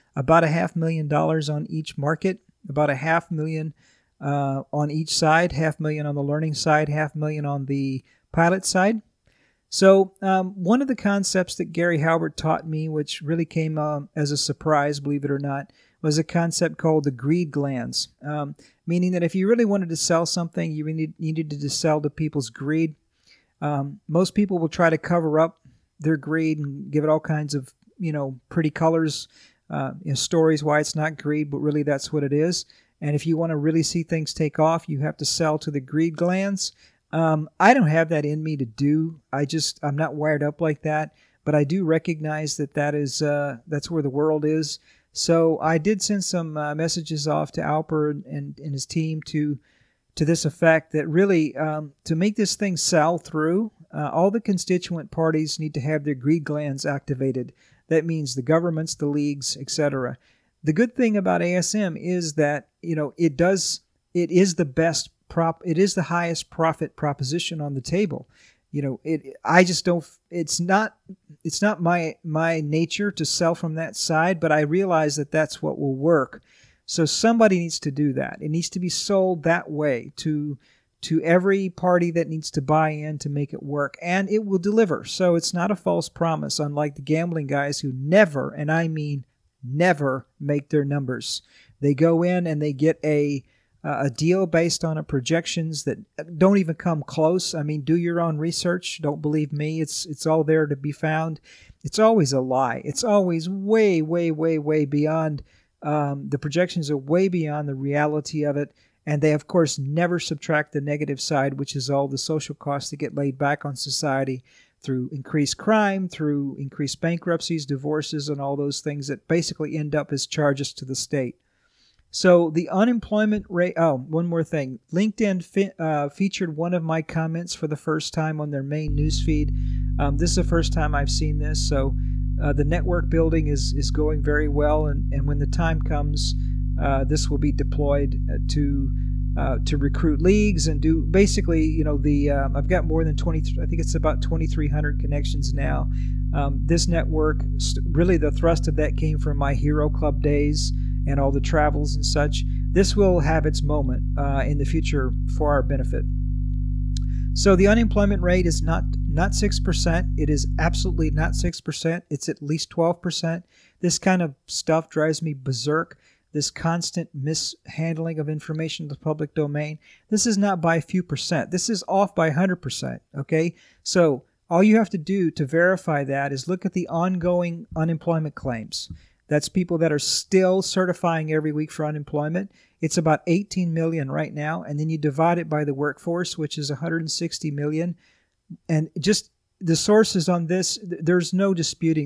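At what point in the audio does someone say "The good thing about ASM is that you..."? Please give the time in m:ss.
1:00.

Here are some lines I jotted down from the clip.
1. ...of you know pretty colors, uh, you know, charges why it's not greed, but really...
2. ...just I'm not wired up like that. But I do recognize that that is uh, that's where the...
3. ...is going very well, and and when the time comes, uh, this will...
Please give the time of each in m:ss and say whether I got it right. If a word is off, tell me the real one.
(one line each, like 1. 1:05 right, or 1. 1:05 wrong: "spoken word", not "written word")
1. 0:27 wrong: "stories", not "charges"
2. 0:39 right
3. 2:13 right.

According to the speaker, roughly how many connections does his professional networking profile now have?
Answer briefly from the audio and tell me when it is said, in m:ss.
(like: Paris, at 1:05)
2,300, at 2:24.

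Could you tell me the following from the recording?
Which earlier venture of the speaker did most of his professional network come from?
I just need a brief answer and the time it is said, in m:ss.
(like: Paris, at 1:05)
Hero Club, at 2:29.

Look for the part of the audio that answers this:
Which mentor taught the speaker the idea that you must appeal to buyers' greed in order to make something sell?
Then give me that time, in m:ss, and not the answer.
0:11.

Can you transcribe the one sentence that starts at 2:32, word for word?
This will have its moment uh, in the future for our benefit.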